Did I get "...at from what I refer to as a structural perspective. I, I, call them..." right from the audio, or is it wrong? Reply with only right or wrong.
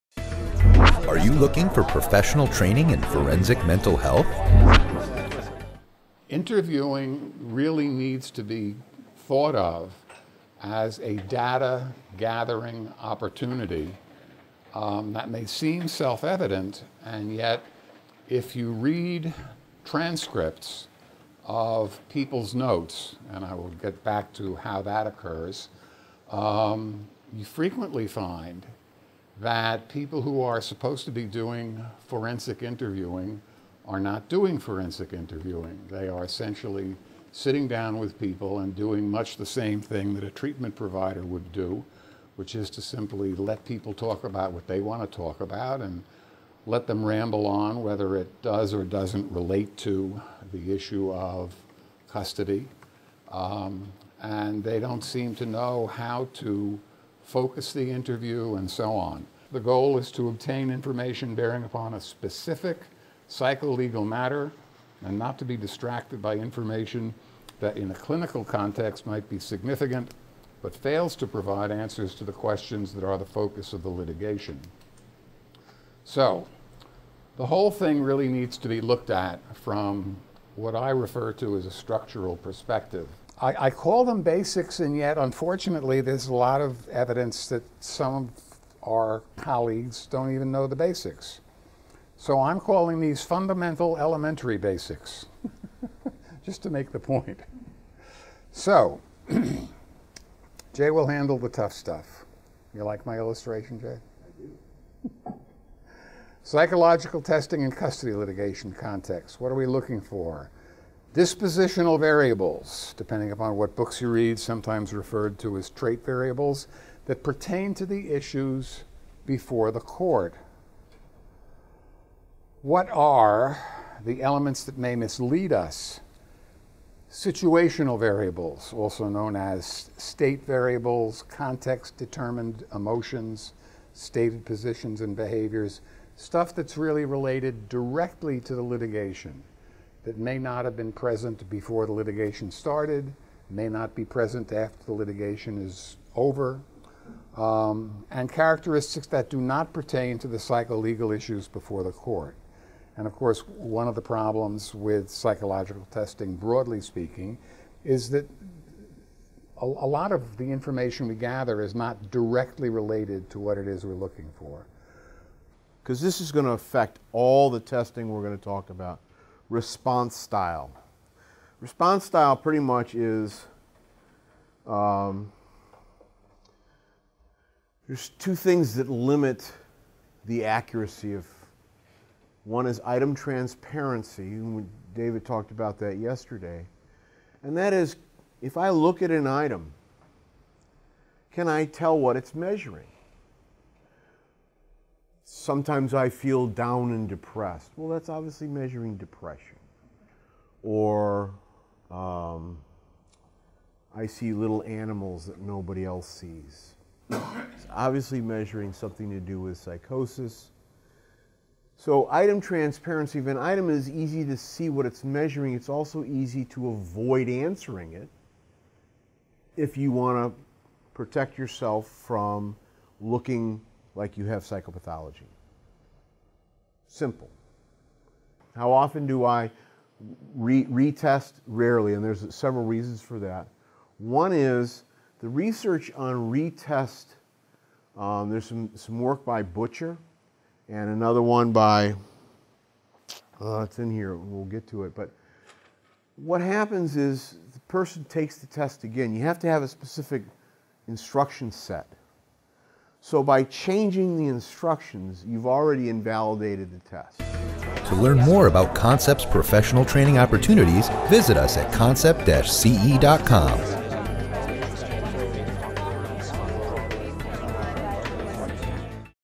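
right.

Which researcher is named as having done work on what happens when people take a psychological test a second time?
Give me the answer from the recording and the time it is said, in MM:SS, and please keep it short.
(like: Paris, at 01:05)
Butcher, at 03:59.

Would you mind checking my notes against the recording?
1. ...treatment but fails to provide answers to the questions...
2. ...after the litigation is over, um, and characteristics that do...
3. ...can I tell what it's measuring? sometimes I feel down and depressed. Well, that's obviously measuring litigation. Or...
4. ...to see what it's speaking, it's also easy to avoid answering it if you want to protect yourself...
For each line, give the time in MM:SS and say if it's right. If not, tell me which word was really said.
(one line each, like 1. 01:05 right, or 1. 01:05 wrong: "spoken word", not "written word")
1. 01:09 wrong: "significant", not "treatment"
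2. 02:24 right
3. 03:11 wrong: "depression", not "litigation"
4. 03:34 wrong: "measuring", not "speaking".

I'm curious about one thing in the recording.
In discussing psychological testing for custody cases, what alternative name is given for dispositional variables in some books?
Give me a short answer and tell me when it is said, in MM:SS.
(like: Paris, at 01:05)
trait variables, at 01:55.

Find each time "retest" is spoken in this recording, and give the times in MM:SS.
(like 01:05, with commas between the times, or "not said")
03:50, 03:56.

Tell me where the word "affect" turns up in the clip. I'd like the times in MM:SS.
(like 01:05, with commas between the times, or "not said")
02:46.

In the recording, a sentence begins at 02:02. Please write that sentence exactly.
What are the elements that may mislead us?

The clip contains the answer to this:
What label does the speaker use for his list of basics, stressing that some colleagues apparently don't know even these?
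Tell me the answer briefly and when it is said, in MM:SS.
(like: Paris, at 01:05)
fundamental elementary basics, at 01:33.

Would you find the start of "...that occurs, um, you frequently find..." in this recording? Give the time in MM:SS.
00:24.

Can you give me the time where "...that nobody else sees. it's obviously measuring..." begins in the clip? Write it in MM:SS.
03:25.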